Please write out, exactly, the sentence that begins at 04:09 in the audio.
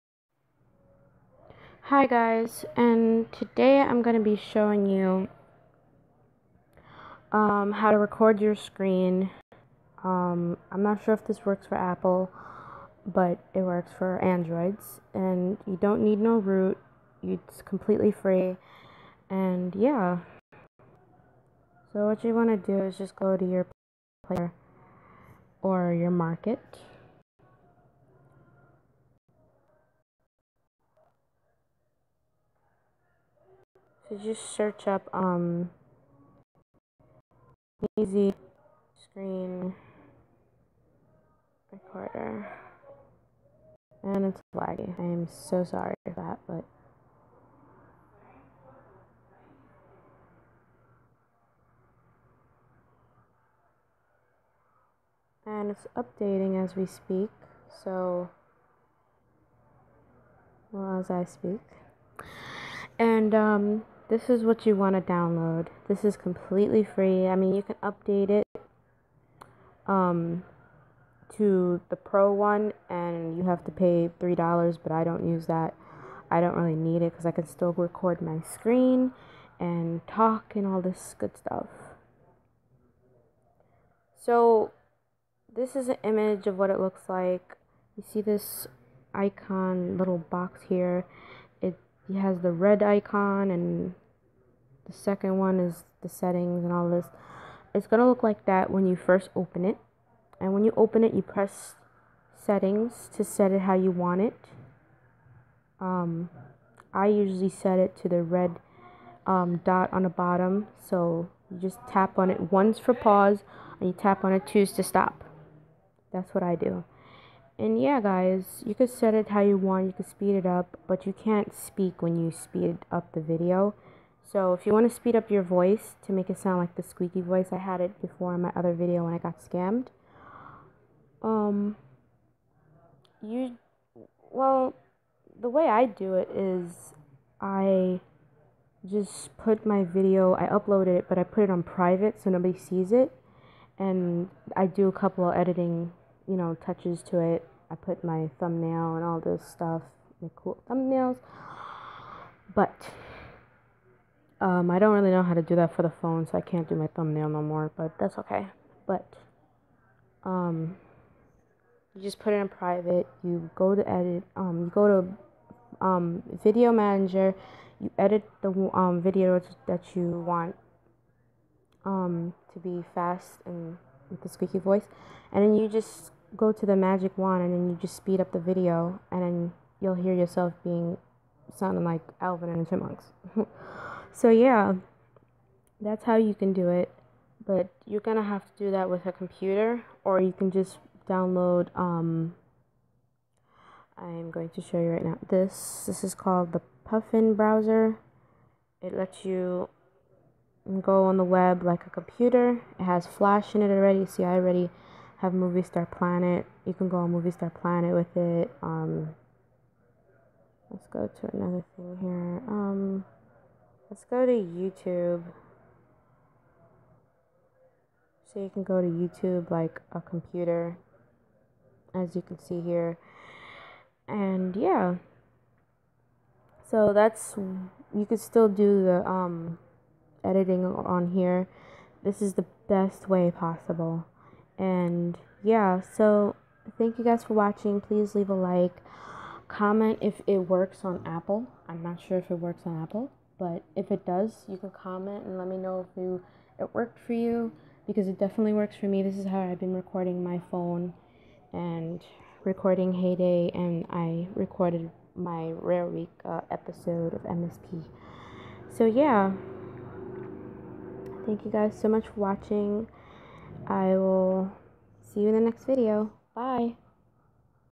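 This is how I've been recording my phone and recording Hay Day, and I recorded my Rare Week uh, episode of MSP.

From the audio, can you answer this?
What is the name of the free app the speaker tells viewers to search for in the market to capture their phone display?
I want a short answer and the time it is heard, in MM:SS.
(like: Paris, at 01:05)
Easy Screen Recorder, at 00:37.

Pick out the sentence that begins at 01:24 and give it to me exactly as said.
So, this is an image of what it looks like.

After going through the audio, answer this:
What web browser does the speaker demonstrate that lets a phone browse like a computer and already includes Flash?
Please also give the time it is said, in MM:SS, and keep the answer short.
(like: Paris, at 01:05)
Puffin browser, at 03:16.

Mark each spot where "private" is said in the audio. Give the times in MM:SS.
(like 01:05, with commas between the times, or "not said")
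02:21, 02:42.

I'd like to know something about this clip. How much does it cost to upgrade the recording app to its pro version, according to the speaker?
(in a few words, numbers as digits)
$3.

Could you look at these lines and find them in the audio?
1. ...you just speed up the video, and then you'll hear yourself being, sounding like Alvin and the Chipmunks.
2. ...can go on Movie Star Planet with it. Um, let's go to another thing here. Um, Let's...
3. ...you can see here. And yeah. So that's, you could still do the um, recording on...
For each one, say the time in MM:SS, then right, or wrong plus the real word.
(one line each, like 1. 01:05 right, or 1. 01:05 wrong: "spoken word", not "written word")
1. 02:57 right
2. 03:26 right
3. 03:42 wrong: "editing", not "recording".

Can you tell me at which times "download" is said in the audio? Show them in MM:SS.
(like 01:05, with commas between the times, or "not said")
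01:05, 03:11.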